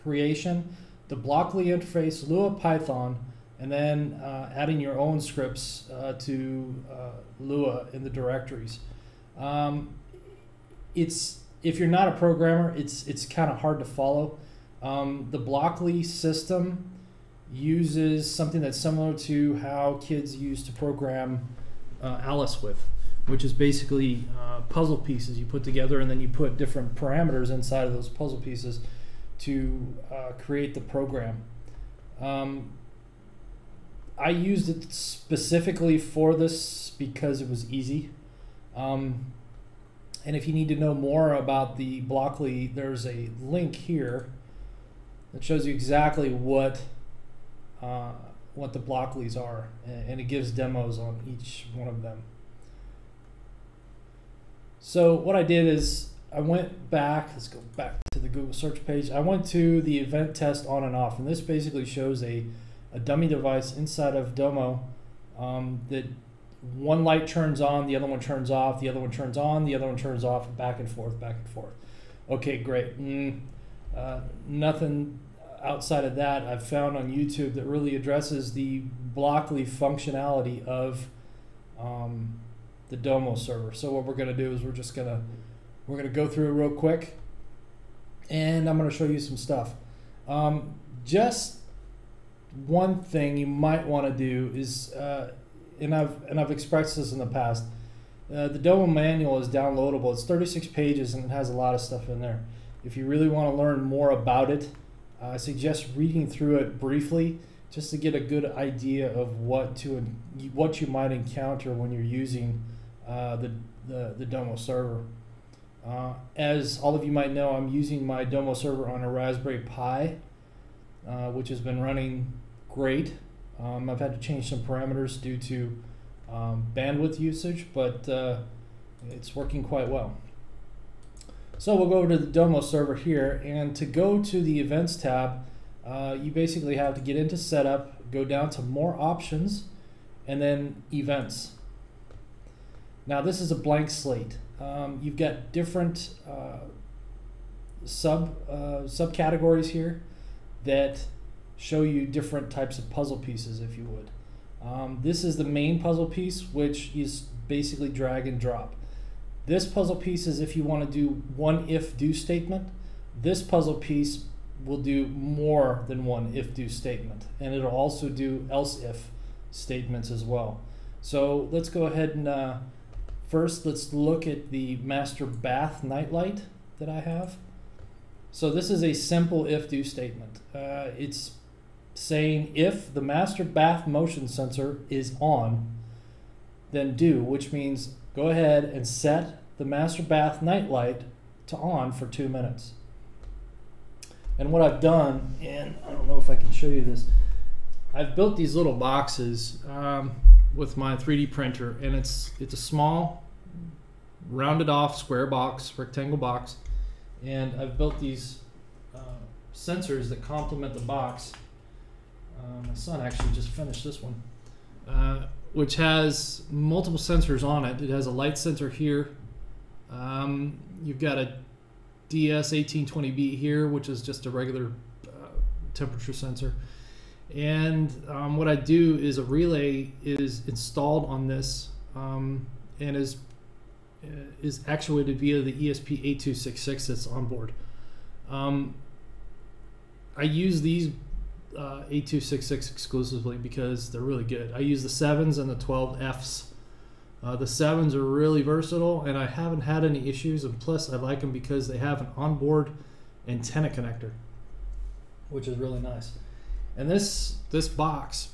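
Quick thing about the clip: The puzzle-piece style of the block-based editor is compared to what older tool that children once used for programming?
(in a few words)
Alice.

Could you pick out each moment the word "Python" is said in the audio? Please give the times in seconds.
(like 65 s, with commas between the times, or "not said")
2 s.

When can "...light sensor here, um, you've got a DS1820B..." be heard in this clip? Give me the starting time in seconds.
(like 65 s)
218 s.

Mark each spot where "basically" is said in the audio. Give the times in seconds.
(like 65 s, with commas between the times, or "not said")
23 s, 61 s, 136 s, 157 s.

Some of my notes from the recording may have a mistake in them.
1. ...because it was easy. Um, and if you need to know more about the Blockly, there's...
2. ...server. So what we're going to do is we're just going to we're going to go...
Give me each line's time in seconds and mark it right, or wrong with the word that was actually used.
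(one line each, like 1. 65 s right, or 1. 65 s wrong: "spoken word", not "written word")
1. 36 s right
2. 83 s right.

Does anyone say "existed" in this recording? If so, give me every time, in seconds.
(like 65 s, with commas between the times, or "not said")
not said.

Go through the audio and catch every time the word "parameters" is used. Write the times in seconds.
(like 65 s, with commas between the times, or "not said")
26 s, 124 s.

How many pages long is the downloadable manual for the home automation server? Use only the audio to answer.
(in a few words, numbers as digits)
36.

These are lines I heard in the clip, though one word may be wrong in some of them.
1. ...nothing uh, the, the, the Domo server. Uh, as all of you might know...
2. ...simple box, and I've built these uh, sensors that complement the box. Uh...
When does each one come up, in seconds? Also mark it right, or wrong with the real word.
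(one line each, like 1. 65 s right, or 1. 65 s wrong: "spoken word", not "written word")
1. 112 s wrong: "using", not "nothing"
2. 205 s wrong: "rectangle", not "simple".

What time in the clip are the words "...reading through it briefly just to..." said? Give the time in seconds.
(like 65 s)
105 s.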